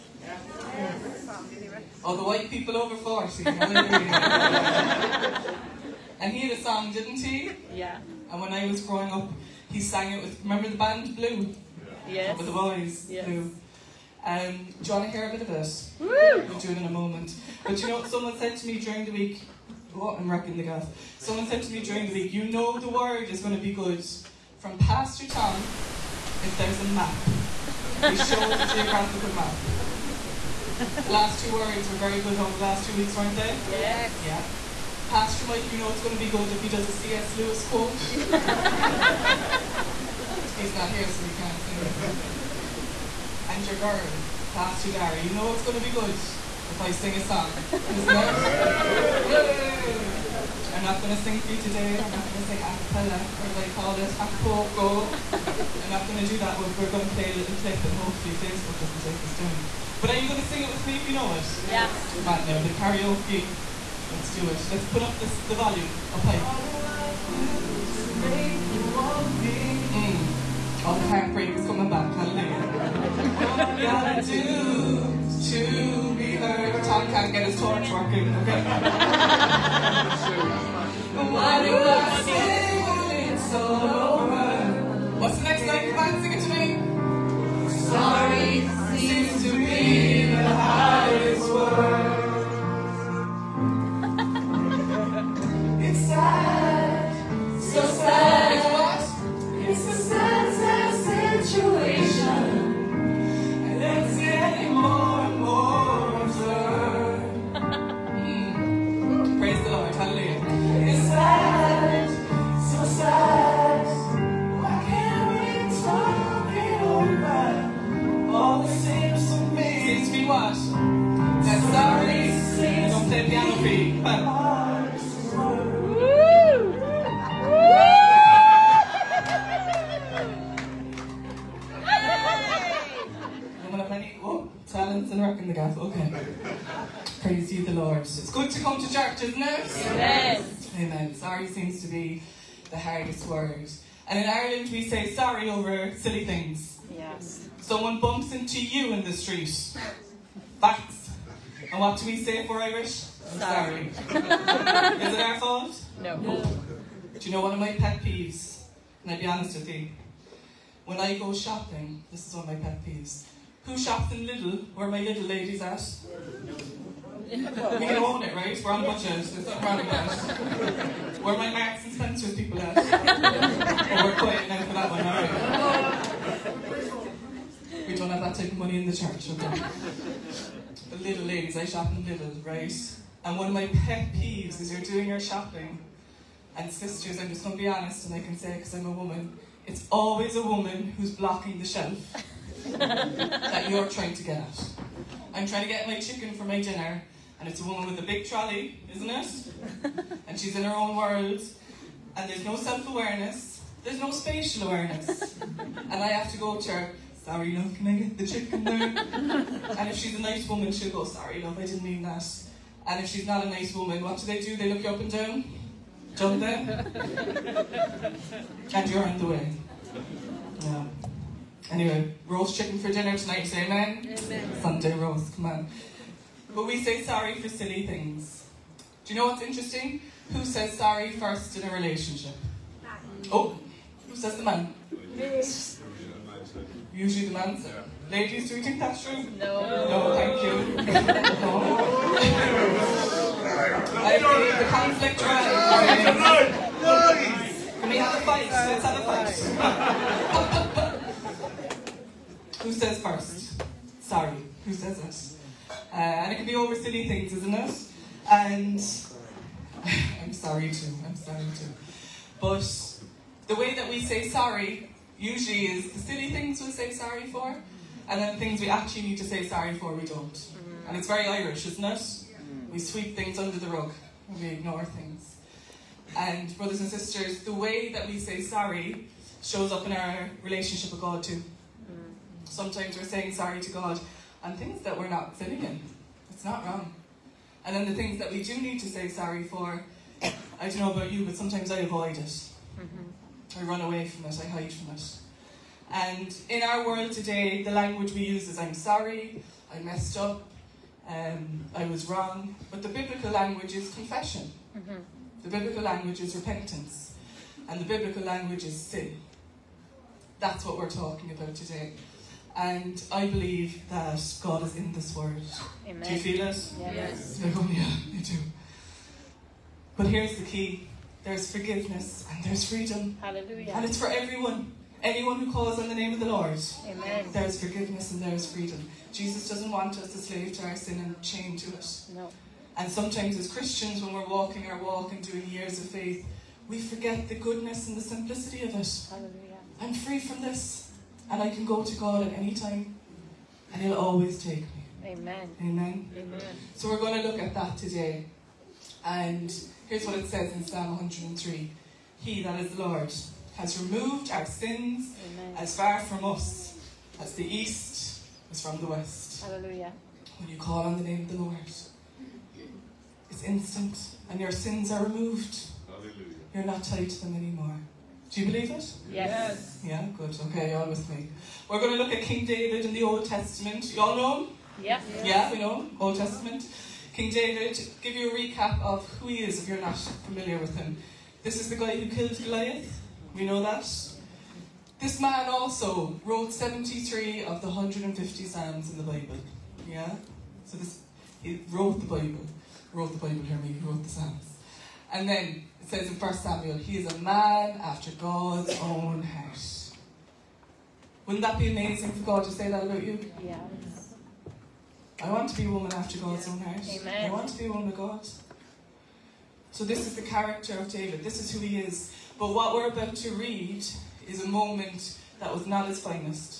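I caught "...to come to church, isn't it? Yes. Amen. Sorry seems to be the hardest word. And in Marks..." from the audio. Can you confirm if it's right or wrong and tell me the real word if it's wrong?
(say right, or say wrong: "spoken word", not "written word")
wrong: "Ireland", not "Marks".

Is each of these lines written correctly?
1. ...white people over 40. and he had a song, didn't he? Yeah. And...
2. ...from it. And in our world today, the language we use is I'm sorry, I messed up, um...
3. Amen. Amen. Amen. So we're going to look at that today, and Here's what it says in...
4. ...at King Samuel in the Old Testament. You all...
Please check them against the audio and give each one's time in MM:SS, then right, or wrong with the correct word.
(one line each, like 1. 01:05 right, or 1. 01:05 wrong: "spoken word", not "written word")
1. 00:02 right
2. 04:54 right
3. 05:45 right
4. 06:12 wrong: "David", not "Samuel".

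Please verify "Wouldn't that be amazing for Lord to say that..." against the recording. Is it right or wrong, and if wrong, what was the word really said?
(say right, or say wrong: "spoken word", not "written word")
wrong: "God", not "Lord".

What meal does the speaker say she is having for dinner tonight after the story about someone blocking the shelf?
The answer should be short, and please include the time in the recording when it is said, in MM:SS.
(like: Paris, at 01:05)
Roast chicken, at 03:42.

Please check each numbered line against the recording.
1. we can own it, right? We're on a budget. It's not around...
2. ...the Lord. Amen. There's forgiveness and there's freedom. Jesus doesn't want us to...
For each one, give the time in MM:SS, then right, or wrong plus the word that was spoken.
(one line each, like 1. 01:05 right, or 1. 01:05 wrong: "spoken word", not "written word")
1. 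02:47 right
2. 05:26 right.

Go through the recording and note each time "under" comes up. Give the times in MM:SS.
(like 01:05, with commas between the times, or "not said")
04:33.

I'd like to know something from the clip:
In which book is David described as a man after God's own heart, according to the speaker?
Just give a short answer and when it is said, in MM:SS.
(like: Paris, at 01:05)
1 Samuel, at 06:36.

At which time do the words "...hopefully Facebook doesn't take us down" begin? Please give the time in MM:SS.
00:57.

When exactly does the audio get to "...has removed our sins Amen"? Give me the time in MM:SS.
05:53.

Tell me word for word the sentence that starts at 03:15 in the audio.
I'm trying to get my chicken for my dinner and it's a woman with a big trolley, isn't it?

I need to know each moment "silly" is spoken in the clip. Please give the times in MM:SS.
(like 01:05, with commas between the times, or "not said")
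02:25, 03:47, 04:16, 04:25.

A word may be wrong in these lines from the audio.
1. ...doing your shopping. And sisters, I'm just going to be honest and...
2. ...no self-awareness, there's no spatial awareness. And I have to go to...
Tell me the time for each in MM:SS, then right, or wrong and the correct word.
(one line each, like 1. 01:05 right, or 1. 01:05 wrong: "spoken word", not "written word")
1. 03:04 right
2. 03:22 right.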